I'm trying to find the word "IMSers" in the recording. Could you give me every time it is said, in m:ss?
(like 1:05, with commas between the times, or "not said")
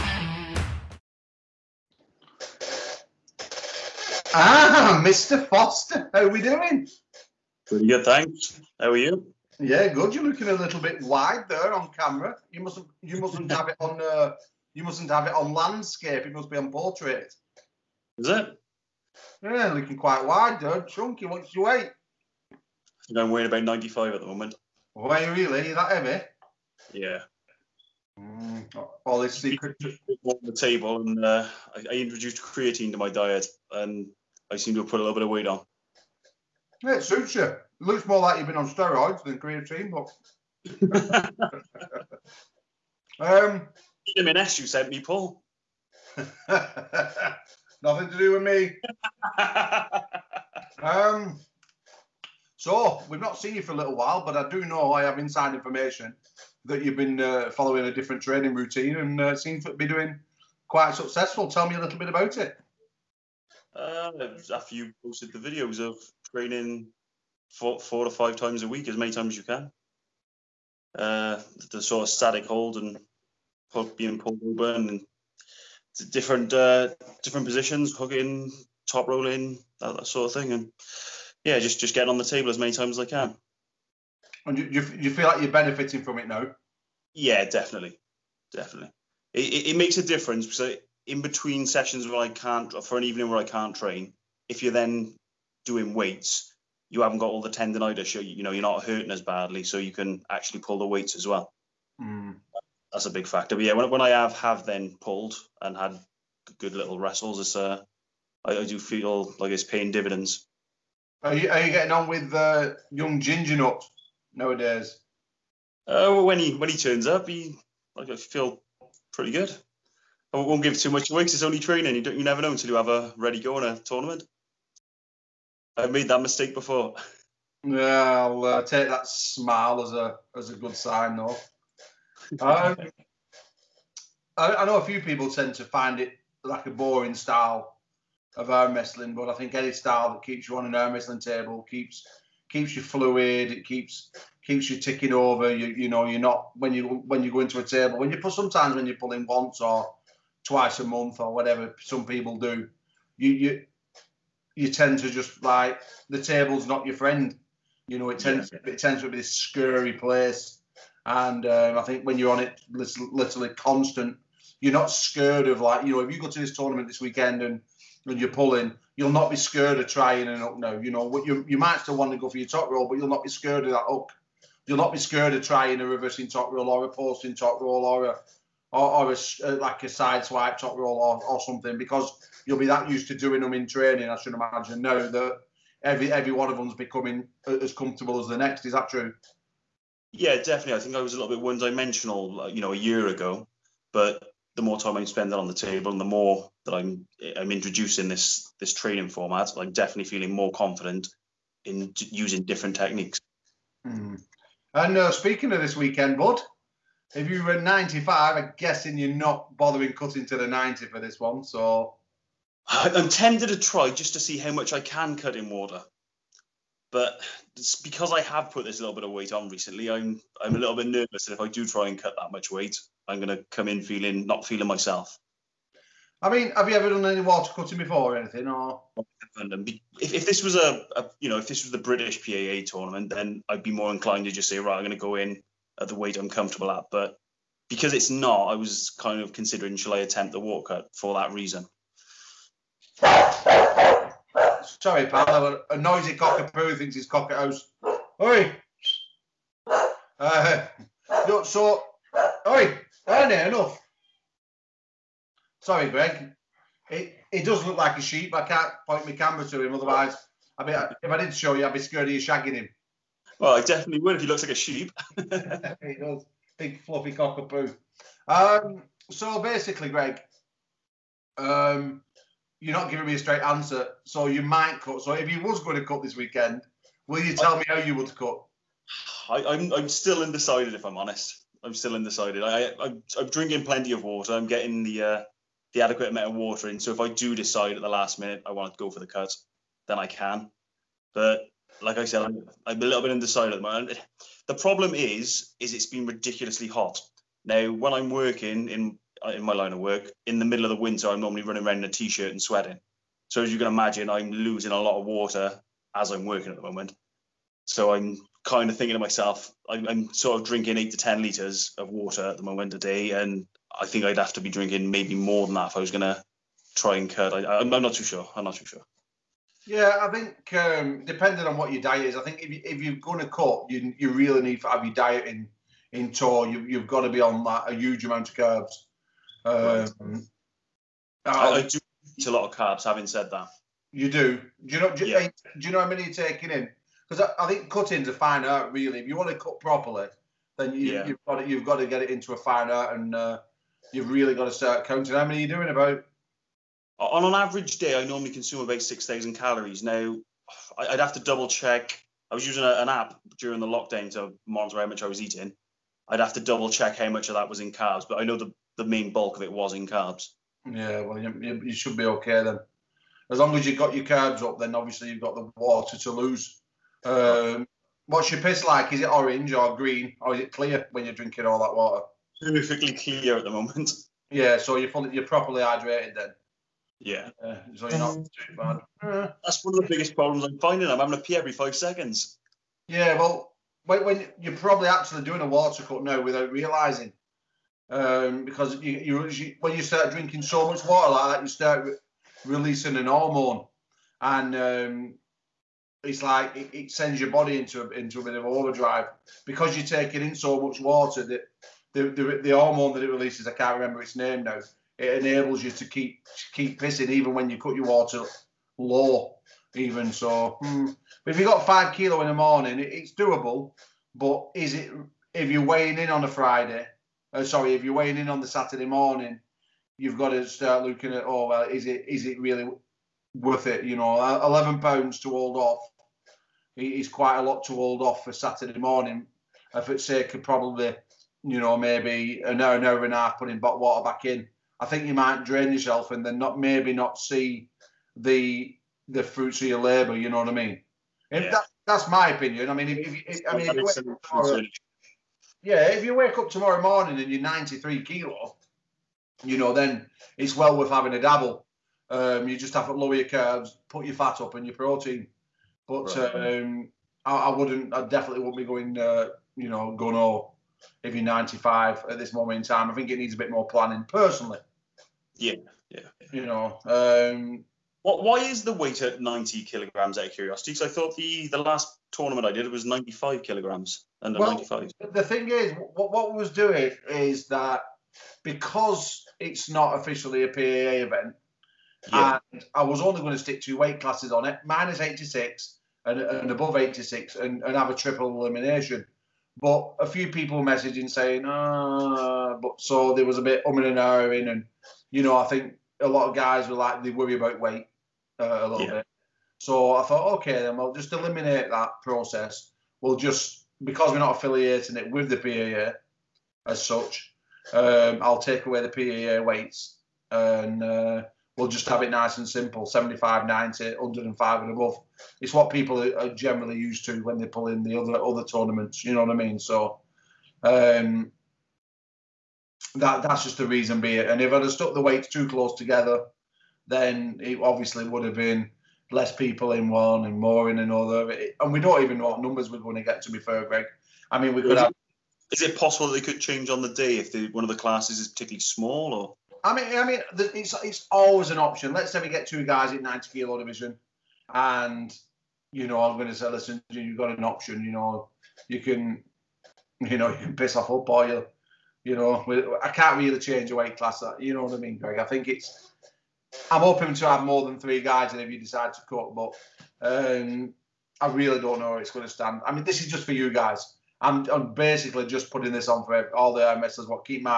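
9:26.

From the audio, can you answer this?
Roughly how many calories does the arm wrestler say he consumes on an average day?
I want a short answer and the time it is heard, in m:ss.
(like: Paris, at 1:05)
6000, at 5:48.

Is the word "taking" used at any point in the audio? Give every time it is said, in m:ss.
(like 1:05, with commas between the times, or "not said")
5:36, 6:39.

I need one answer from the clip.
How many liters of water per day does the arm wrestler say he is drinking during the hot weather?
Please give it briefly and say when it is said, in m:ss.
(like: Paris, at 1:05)
8 to 10 liters, at 5:10.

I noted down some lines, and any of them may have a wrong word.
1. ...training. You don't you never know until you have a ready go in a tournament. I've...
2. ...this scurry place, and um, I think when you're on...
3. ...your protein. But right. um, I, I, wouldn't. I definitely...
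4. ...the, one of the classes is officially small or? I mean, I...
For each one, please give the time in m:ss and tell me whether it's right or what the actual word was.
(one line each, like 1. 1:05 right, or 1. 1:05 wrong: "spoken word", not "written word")
1. 2:01 right
2. 2:39 right
3. 7:34 right
4. 8:57 wrong: "particularly", not "officially".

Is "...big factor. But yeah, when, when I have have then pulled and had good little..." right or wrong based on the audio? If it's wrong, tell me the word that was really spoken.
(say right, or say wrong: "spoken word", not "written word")
right.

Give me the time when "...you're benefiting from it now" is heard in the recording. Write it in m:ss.
1:25.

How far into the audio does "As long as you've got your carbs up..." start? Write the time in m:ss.
6:03.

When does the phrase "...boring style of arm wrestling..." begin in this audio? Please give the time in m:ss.
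2:16.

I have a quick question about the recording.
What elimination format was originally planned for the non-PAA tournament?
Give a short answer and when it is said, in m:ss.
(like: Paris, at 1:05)
triple elimination, at 8:07.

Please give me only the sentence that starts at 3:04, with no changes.
I should imagine now that every every one of them's becoming as comfortable as the next.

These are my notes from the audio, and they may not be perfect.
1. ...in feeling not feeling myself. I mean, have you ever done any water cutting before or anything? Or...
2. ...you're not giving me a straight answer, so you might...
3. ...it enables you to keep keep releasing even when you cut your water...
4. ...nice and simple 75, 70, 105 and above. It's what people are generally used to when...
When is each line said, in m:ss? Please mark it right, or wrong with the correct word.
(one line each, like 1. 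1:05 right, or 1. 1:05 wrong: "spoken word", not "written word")
1. 3:43 right
2. 4:32 right
3. 6:44 wrong: "pissing", not "releasing"
4. 8:32 wrong: "90", not "70".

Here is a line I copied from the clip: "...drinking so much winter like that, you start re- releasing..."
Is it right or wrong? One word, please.
wrong.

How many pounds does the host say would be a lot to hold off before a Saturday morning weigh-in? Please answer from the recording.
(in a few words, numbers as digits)
11 pounds.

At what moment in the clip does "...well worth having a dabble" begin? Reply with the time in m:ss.
7:30.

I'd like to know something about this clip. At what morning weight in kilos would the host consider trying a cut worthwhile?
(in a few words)
93.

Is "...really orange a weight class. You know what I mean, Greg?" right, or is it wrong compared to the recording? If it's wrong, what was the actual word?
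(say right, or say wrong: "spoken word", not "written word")
wrong: "change", not "orange".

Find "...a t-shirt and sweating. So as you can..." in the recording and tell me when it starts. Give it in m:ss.
5:01.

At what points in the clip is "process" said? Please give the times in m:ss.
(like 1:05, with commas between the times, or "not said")
8:22.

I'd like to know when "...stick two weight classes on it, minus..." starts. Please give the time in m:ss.
8:03.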